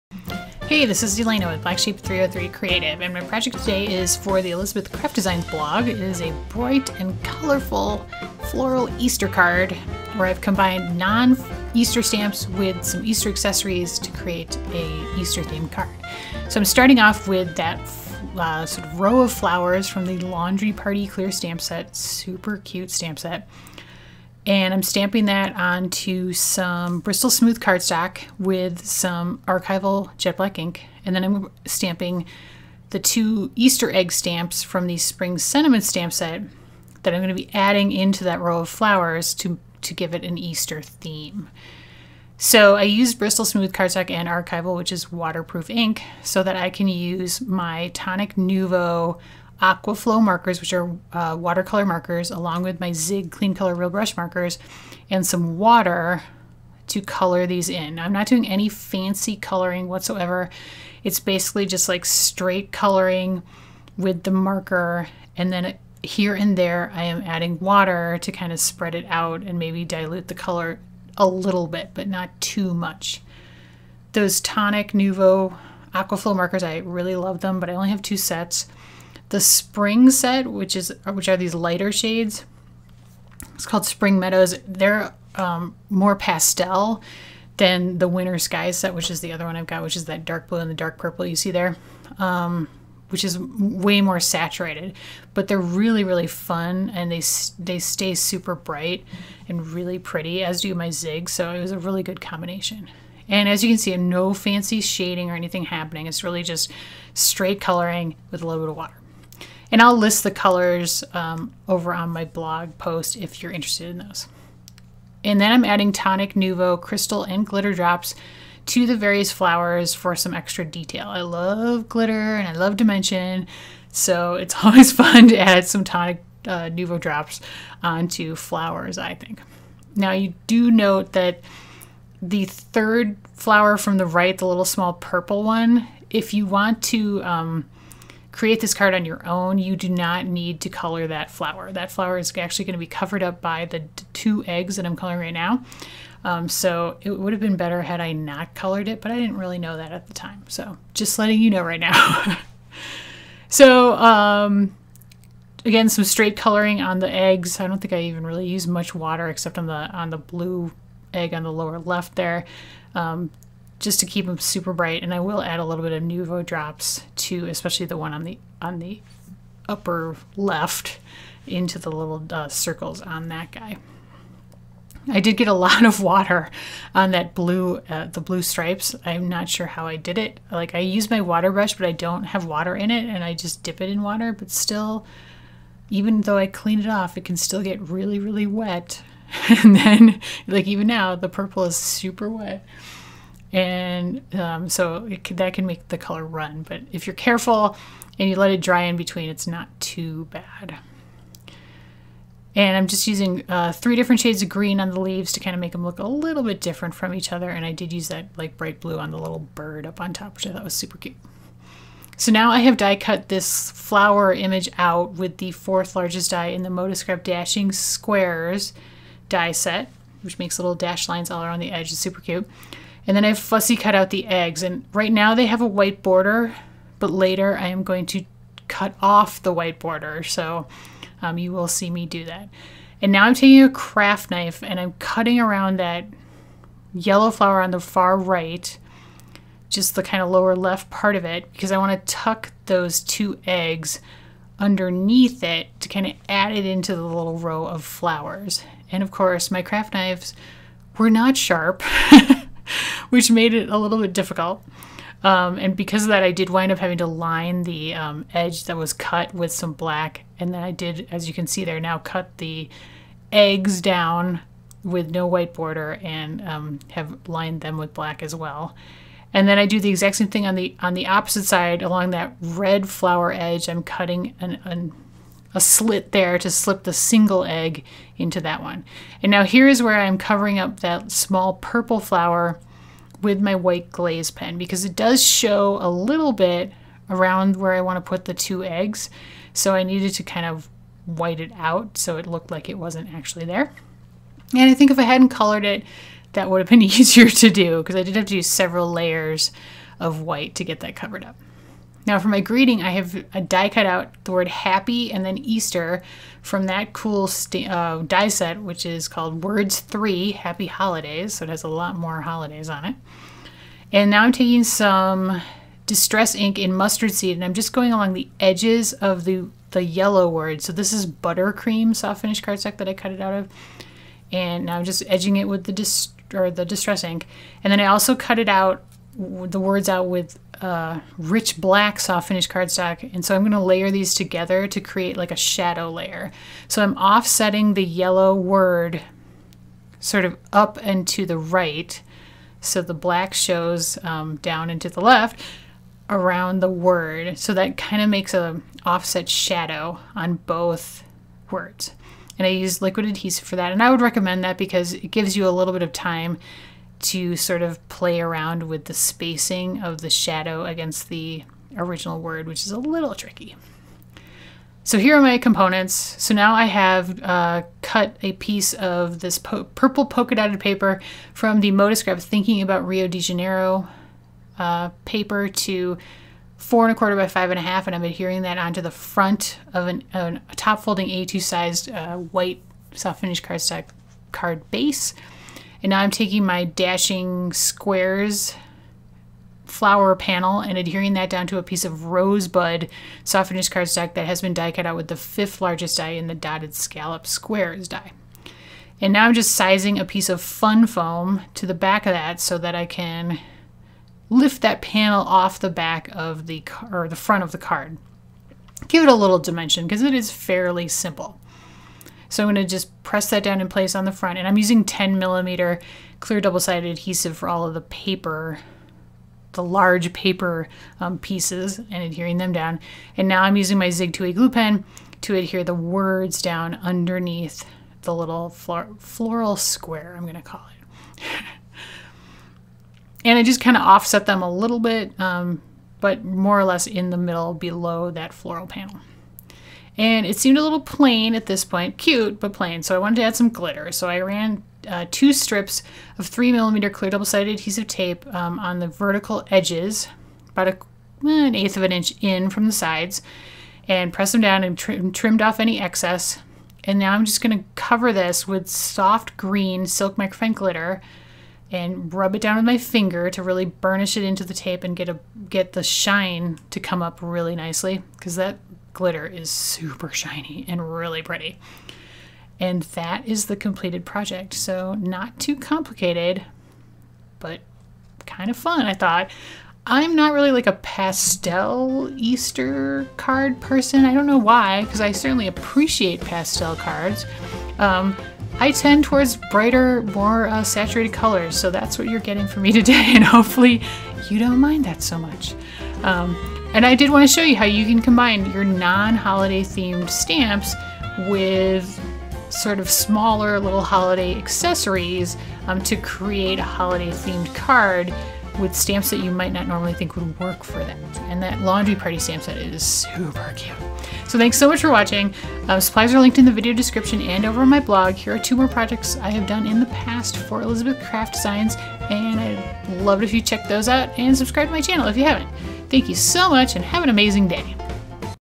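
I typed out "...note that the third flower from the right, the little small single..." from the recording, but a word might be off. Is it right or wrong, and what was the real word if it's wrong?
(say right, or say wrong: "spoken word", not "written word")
wrong: "purple", not "single".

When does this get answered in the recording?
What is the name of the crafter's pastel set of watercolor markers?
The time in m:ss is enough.
1:23.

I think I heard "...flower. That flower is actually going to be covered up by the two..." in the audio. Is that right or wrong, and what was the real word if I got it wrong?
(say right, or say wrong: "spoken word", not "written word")
right.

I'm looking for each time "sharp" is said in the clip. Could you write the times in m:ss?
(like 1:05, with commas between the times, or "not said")
4:11.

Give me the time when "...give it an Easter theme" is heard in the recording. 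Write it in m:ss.
0:39.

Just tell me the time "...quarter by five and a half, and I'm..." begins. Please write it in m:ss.
6:16.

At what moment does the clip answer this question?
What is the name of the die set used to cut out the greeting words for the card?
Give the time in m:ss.
5:09.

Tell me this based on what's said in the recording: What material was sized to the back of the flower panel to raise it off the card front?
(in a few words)
Fun foam.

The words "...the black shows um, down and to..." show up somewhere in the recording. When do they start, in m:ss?
5:42.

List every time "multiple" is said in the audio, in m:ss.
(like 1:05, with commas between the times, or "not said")
not said.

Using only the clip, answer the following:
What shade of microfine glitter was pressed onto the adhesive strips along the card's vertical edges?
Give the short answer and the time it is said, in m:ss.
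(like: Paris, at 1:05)
Soft green silk, at 7:38.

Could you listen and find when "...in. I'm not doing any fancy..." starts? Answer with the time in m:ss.
0:57.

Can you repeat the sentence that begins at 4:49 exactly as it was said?
So I needed to kind of white it out so it looked like it wasn't actually there.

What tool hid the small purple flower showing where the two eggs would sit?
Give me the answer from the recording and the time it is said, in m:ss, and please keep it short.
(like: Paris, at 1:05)
White glaze pen, at 4:43.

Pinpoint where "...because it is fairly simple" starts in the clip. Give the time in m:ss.
6:49.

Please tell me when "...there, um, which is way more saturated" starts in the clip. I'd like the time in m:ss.
1:31.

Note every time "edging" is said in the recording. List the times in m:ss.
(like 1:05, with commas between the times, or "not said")
5:25.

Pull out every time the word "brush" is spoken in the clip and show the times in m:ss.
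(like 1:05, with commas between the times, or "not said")
0:53, 3:01.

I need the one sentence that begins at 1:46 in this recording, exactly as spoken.
It's really just straight coloring with a little bit of water.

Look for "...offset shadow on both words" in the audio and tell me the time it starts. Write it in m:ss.
5:48.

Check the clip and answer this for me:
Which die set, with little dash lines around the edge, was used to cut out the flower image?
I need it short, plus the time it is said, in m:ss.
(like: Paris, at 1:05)
Modascrap Dashing Squares, at 3:36.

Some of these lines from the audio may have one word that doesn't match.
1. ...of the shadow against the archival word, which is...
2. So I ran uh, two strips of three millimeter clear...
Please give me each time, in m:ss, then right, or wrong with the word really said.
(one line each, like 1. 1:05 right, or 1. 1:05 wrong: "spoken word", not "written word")
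1. 5:59 wrong: "original", not "archival"
2. 7:23 right.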